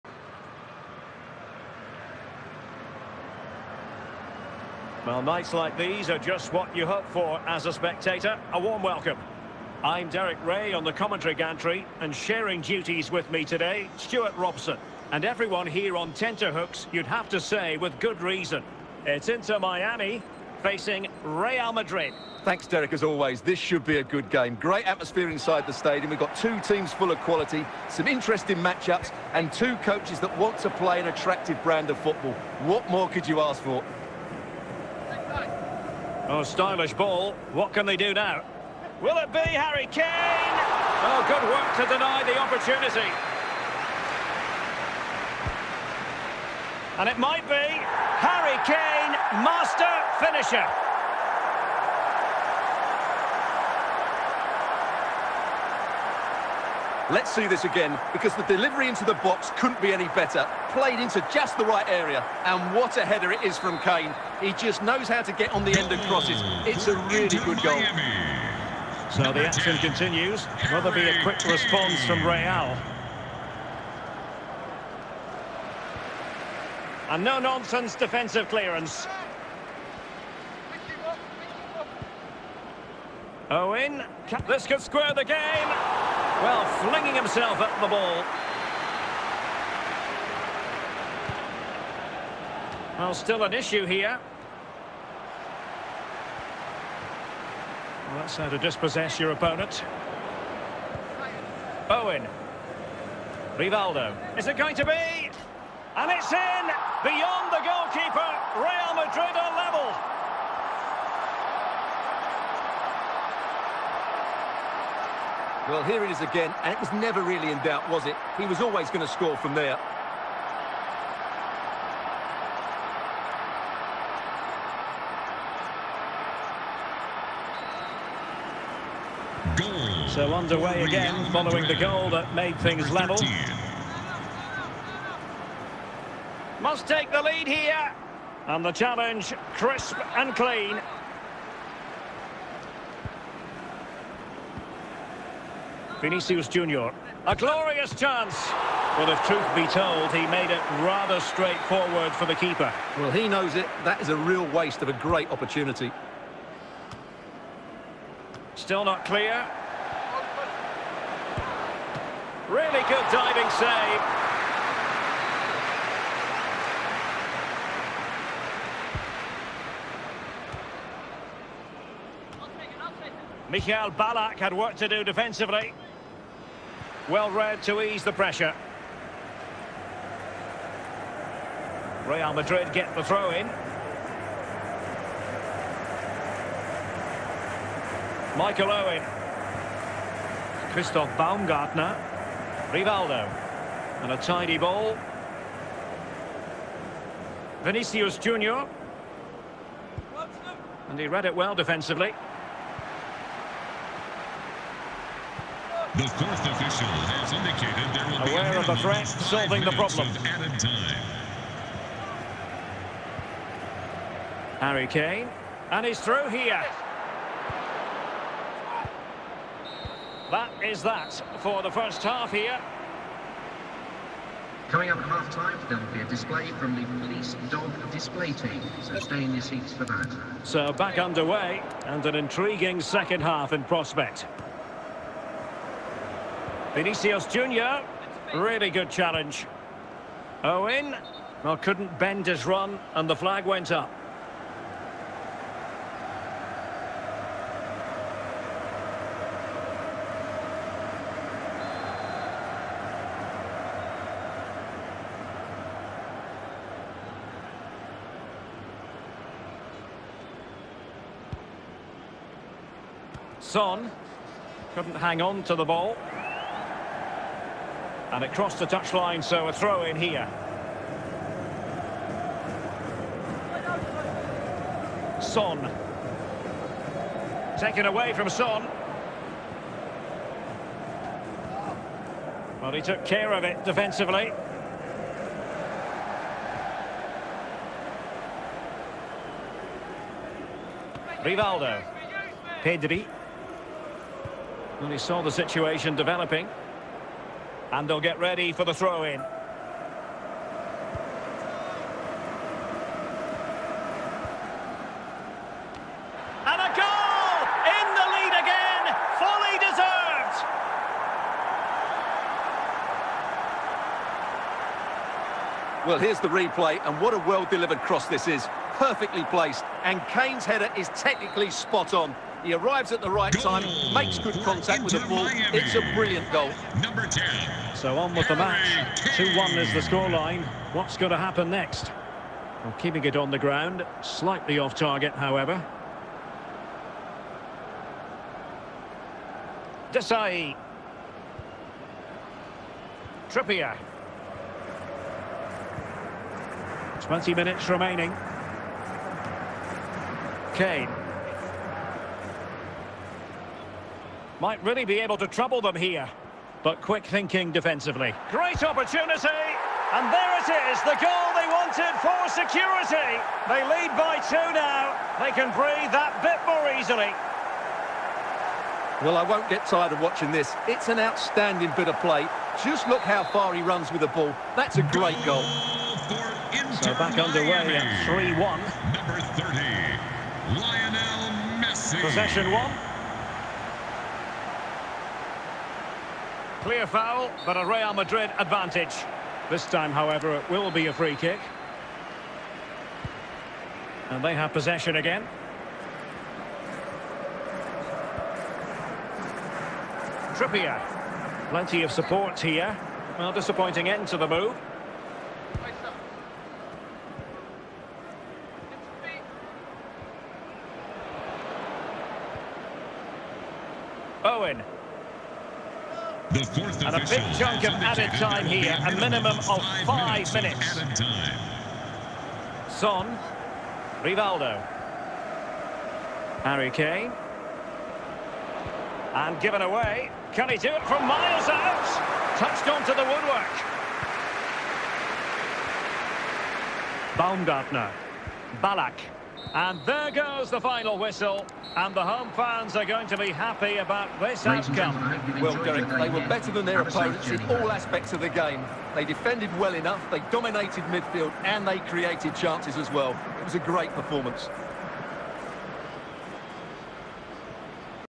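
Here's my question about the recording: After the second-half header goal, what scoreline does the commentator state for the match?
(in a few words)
2-1.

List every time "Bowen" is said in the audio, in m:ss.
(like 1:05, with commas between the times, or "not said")
1:41.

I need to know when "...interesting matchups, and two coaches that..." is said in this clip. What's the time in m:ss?
0:28.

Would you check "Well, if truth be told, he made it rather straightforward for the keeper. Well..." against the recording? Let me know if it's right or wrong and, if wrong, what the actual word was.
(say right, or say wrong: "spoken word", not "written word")
right.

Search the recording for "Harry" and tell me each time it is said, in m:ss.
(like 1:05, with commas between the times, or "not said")
0:39, 0:48, 3:34, 5:28, 7:06.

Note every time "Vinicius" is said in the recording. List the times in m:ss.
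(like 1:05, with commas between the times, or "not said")
2:26, 3:17, 3:56.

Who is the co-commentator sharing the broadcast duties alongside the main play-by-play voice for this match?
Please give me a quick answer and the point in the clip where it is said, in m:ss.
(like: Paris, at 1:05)
Stuart Robson, at 0:13.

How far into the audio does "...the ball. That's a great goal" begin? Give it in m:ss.
6:14.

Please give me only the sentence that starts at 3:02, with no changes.
Real Madrid get the throw in.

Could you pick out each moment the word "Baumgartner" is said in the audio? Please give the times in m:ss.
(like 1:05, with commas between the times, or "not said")
3:11, 7:17.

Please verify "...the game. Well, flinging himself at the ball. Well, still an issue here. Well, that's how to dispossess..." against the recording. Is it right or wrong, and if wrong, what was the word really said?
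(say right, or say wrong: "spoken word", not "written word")
right.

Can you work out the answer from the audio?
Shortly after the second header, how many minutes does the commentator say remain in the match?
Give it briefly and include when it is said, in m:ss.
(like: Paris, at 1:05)
20, at 5:47.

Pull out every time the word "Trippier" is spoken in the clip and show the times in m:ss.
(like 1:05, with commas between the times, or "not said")
5:43, 6:40.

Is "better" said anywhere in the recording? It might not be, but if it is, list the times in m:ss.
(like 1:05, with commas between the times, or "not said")
1:00, 7:26.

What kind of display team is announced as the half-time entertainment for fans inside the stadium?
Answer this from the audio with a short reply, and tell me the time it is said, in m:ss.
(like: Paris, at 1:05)
Police dog display team, at 3:47.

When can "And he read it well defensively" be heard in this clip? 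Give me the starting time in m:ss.
3:20.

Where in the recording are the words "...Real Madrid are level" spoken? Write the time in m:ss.
1:48.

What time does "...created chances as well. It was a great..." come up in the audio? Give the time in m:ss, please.
7:31.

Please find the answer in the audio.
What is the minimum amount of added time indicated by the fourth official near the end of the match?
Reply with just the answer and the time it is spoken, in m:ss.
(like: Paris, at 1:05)
5 minutes, at 6:59.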